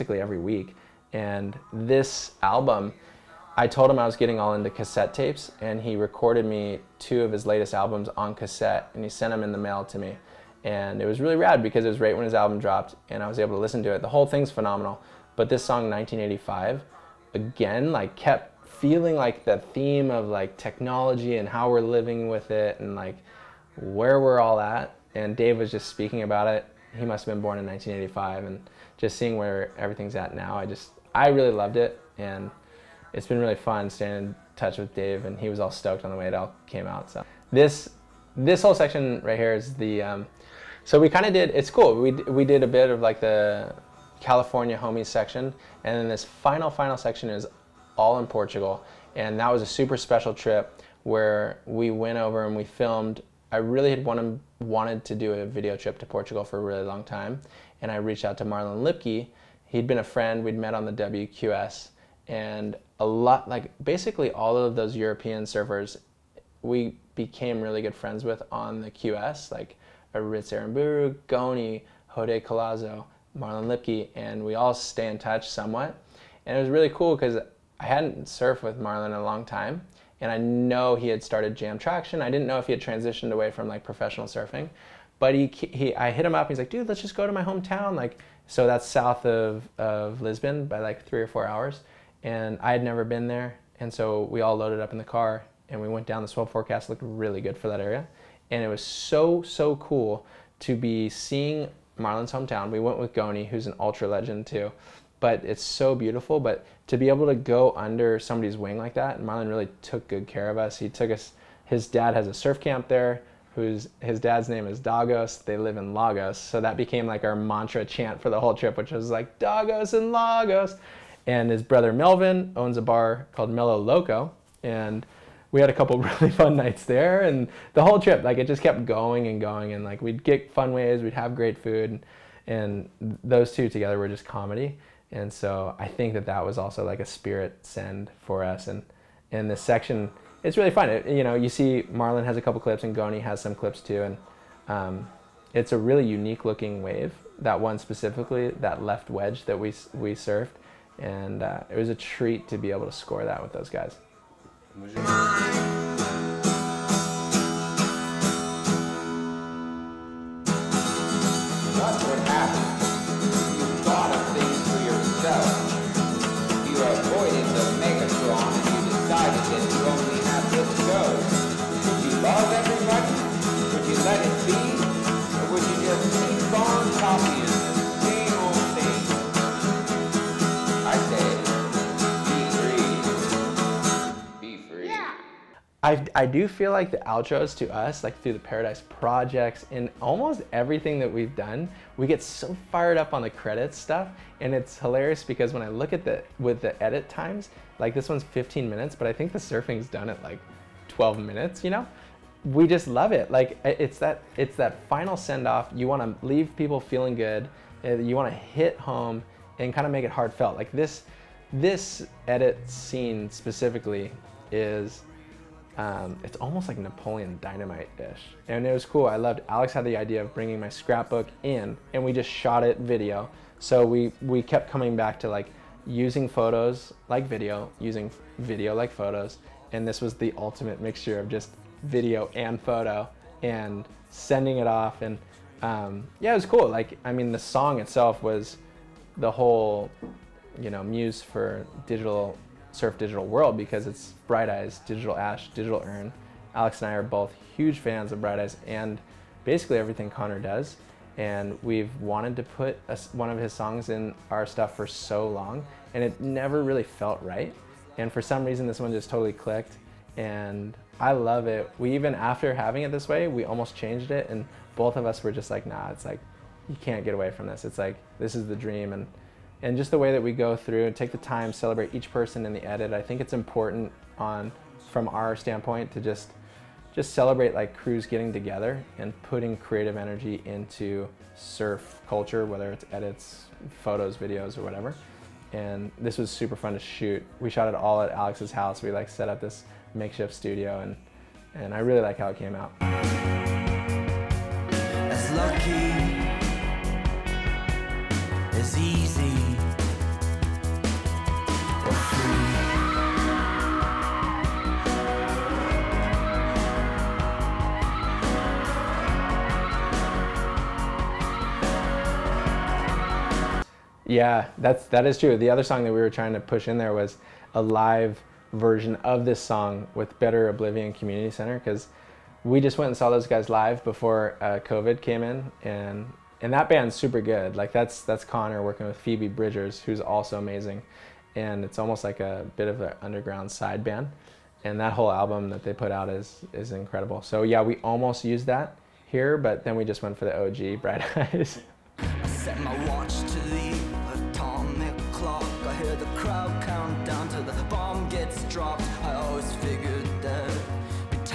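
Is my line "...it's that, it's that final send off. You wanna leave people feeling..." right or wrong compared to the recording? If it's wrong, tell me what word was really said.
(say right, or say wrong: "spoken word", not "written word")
right.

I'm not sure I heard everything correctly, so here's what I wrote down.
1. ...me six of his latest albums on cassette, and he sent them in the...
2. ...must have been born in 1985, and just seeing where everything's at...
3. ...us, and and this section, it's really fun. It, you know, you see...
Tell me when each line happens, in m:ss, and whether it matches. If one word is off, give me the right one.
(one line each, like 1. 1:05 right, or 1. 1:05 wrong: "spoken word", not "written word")
1. 0:06 wrong: "two", not "six"
2. 0:27 right
3. 2:18 right.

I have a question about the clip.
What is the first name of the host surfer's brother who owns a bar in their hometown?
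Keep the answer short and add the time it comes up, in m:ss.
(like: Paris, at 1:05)
Melvin, at 2:01.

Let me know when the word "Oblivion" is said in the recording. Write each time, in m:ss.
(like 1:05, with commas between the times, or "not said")
5:20.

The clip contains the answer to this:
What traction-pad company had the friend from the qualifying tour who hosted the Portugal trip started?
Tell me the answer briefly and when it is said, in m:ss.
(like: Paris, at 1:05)
Jam Traction, at 1:21.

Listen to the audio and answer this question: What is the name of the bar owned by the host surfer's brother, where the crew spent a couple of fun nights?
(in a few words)
Mellow Loco.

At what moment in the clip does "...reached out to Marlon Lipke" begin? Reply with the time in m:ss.
0:57.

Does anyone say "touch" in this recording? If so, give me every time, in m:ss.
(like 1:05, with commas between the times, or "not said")
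0:34, 1:15.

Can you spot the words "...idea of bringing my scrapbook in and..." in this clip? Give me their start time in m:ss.
3:39.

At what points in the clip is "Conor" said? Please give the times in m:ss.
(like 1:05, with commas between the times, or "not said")
4:10, 5:28.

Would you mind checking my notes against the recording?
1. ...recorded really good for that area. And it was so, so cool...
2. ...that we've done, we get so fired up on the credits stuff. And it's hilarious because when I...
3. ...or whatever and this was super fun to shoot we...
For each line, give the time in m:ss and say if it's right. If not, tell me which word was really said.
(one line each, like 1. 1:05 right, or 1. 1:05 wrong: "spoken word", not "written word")
1. 1:36 wrong: "looked", not "recorded"
2. 3:10 right
3. 4:44 right.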